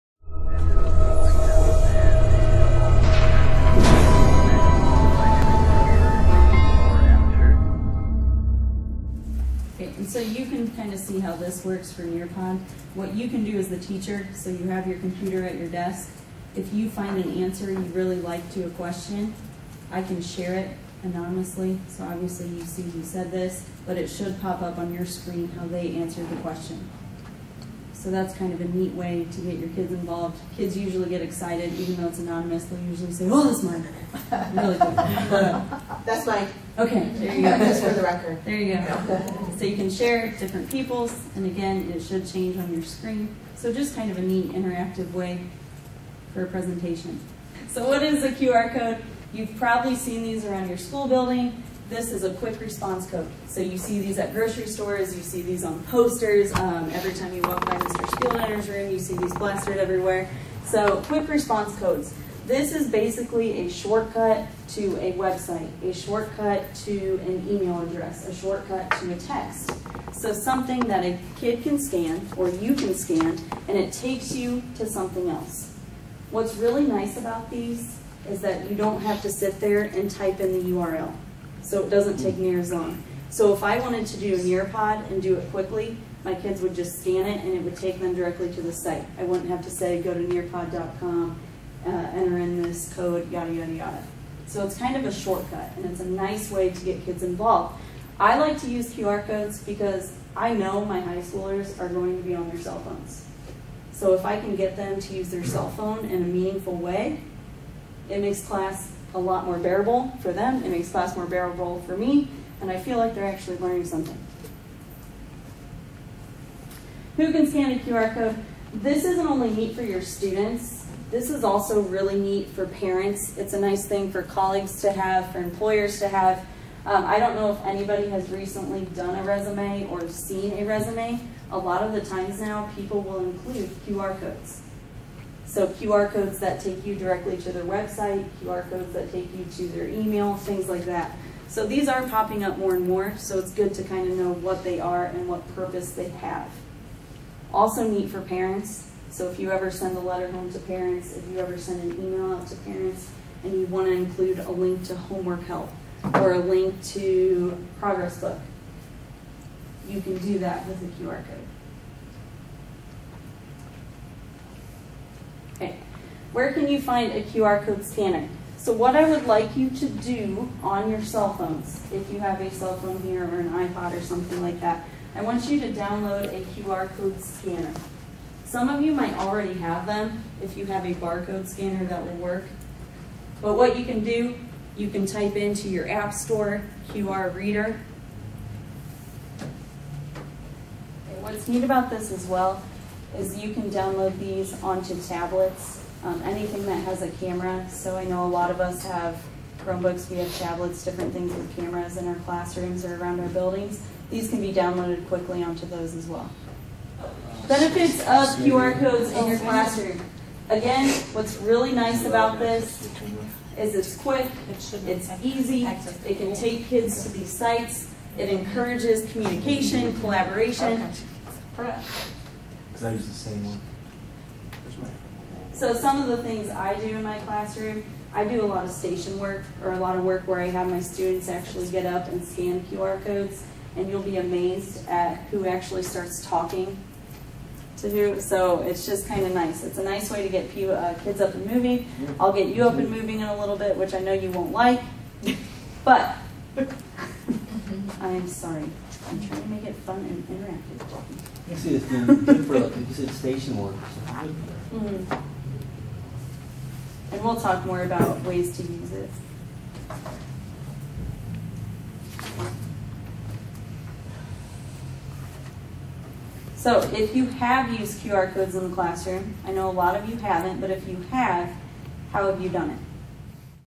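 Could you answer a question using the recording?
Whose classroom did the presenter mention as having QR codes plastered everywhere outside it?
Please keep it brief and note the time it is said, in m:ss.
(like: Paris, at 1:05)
Mr. Spieldenner, at 0:57.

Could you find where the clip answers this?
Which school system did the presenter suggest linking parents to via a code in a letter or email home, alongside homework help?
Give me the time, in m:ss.
2:37.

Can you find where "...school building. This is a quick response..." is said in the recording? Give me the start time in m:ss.
0:50.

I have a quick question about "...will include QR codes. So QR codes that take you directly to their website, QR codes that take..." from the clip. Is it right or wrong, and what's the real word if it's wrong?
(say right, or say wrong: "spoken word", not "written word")
right.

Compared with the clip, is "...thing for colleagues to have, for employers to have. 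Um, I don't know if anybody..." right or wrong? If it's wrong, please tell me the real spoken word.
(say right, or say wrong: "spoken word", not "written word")
right.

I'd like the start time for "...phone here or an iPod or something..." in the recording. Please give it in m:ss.
2:52.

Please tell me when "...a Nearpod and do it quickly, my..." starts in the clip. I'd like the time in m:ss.
1:24.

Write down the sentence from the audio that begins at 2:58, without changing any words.
Some of you might already have them if you have a barcode scanner that will work.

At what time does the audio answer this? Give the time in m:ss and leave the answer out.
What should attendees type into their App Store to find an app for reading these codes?
3:06.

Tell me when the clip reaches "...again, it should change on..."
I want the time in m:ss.
0:41.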